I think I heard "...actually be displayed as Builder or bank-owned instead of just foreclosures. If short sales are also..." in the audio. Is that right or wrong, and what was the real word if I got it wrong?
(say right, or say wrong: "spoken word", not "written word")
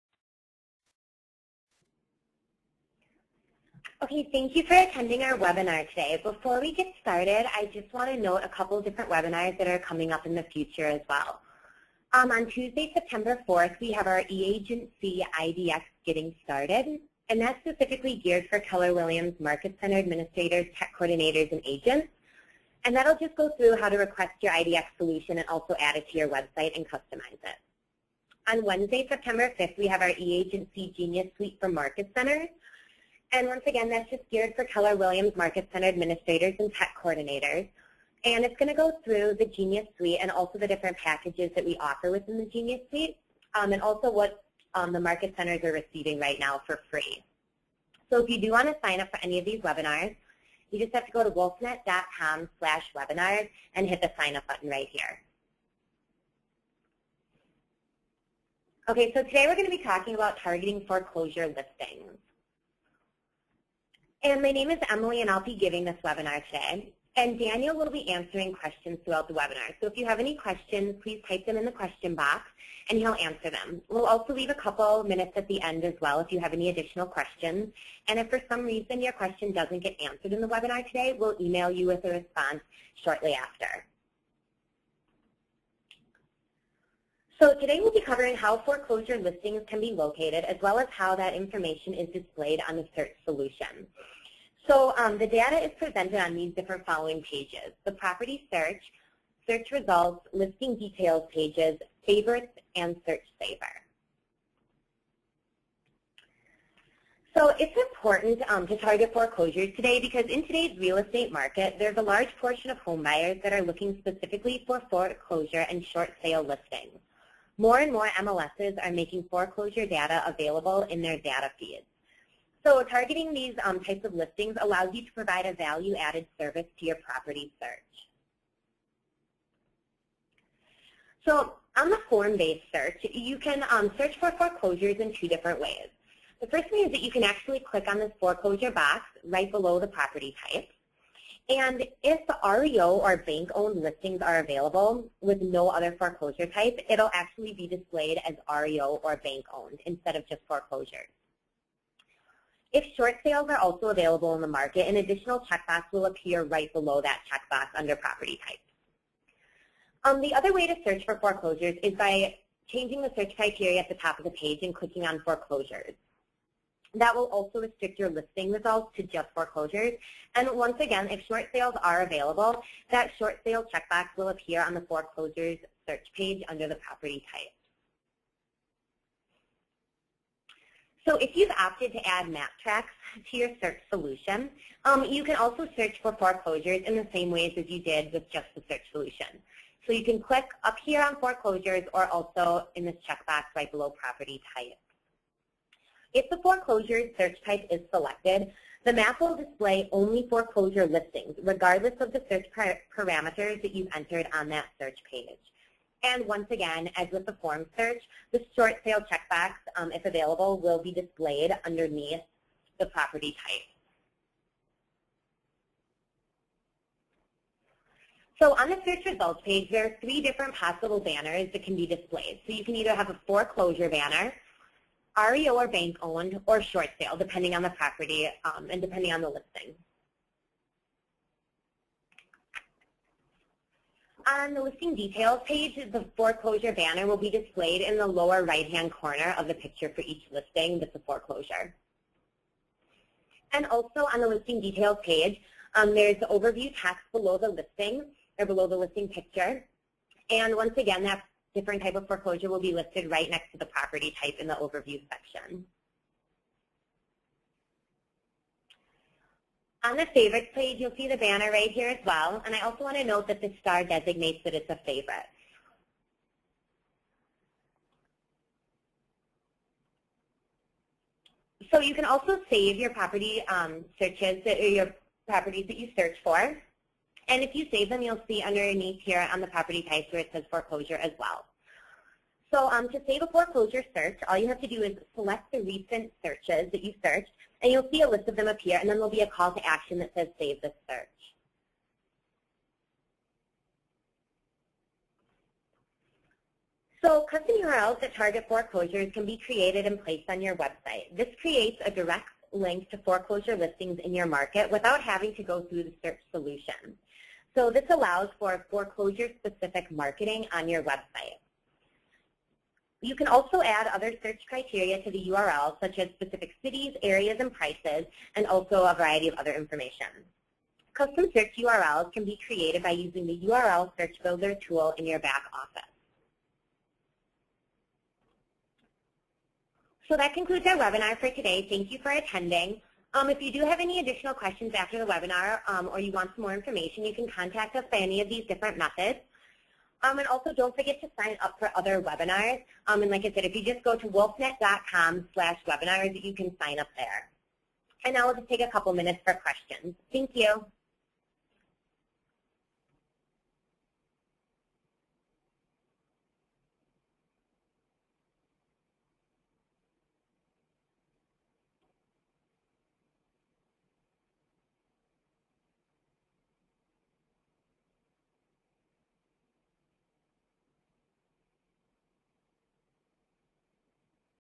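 wrong: "REO", not "Builder".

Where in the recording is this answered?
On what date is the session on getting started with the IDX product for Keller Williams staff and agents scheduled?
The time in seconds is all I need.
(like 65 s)
12 s.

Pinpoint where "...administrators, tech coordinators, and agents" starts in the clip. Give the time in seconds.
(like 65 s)
19 s.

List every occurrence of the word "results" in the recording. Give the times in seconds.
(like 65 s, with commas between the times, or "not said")
99 s, 168 s, 219 s.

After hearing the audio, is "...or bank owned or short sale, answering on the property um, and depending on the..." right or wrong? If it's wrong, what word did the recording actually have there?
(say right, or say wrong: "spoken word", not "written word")
wrong: "depending", not "answering".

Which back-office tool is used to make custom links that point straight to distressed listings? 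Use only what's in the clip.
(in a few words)
URL Search Builder.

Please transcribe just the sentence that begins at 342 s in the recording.
Um, and like I said, if you just go to wolfnet.com slash webinars, you can sign up there.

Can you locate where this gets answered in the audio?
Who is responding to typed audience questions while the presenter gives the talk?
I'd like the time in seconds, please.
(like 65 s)
67 s.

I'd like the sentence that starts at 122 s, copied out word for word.
So targeting these um, types of listings allows you to provide a value-added service to your property search.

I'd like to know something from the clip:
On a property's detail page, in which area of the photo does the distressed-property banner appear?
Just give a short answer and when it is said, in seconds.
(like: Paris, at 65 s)
Lower right-hand corner, at 238 s.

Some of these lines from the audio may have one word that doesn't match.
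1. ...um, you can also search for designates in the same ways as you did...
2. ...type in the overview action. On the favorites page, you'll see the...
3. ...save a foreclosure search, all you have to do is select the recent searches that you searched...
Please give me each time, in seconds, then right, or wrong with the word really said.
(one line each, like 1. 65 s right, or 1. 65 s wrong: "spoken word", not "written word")
1. 184 s wrong: "foreclosures", not "designates"
2. 254 s wrong: "section", not "action"
3. 283 s right.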